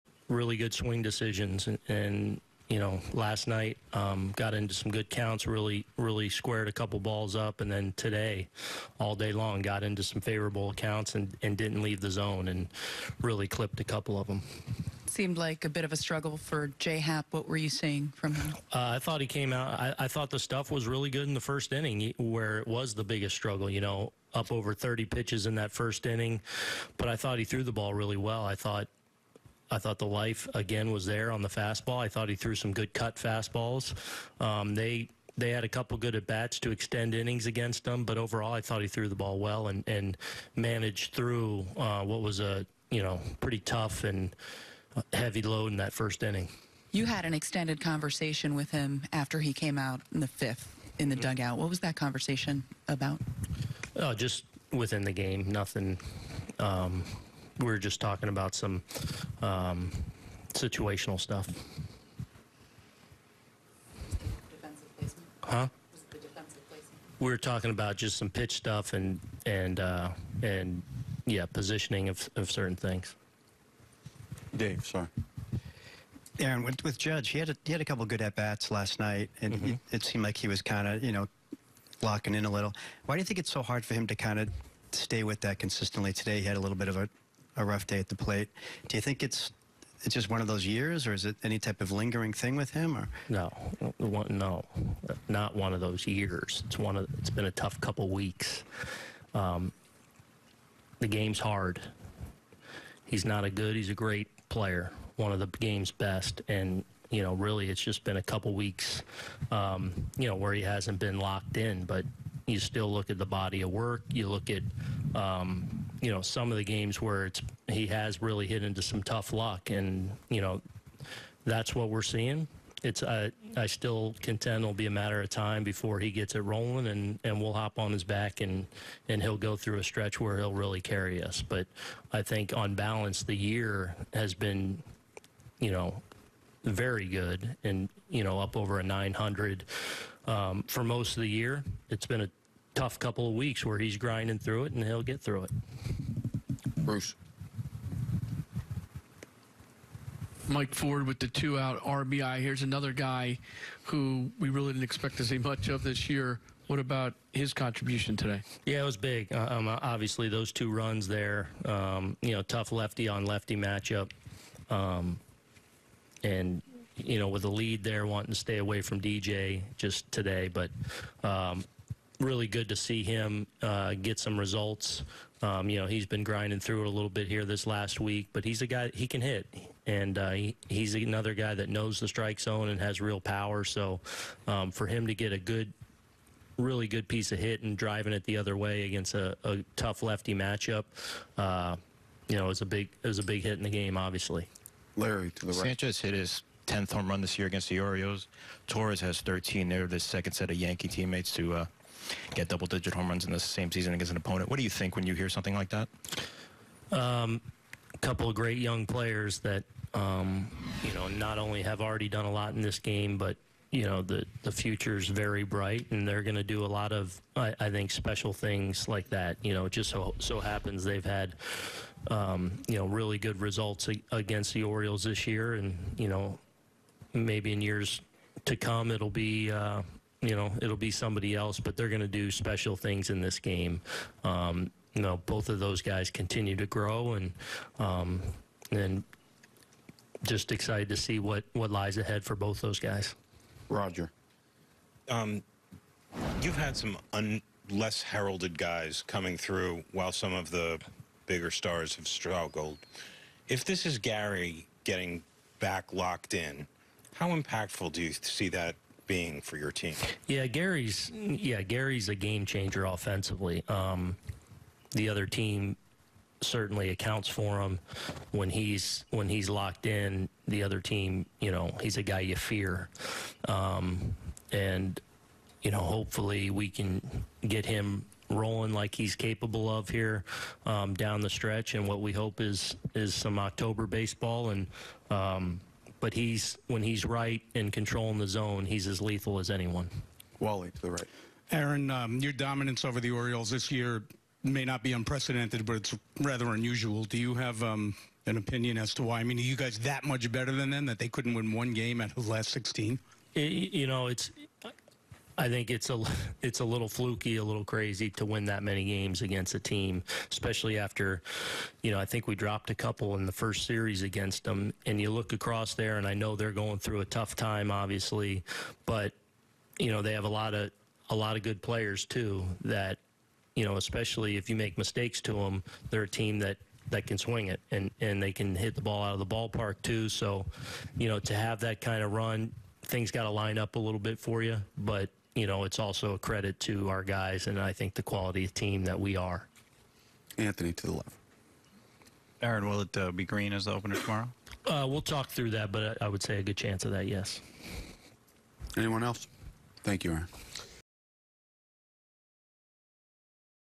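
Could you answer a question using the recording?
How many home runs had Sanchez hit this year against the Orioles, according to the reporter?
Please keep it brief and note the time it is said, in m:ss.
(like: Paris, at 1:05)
10, at 3:16.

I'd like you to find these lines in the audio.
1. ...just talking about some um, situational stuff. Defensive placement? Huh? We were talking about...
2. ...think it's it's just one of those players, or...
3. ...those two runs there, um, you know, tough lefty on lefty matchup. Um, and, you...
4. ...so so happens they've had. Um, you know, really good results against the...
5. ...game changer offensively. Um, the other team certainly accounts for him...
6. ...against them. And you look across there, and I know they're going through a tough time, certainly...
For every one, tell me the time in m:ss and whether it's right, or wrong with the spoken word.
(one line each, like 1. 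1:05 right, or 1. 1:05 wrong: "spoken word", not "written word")
1. 0:57 right
2. 1:29 wrong: "years", not "players"
3. 2:40 right
4. 3:39 right
5. 4:22 right
6. 5:14 wrong: "obviously", not "certainly".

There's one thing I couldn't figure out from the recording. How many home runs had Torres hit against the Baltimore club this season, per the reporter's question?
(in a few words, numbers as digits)
13.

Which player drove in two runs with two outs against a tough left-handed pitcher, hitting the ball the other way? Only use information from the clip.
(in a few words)
Mike Ford.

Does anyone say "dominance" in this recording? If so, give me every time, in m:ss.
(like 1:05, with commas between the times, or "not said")
4:52.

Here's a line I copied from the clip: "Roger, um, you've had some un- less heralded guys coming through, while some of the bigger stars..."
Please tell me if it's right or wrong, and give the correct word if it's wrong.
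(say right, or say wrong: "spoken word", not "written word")
right.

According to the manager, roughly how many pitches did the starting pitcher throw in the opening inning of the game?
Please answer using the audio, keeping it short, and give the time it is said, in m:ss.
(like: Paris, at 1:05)
over 30, at 0:24.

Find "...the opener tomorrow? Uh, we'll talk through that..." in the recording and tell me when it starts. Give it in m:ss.
5:43.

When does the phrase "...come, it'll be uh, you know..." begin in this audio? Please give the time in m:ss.
3:48.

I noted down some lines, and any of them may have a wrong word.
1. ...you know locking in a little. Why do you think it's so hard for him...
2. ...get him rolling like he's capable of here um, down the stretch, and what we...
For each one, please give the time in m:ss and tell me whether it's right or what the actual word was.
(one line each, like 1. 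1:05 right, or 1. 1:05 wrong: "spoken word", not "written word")
1. 1:21 right
2. 4:37 right.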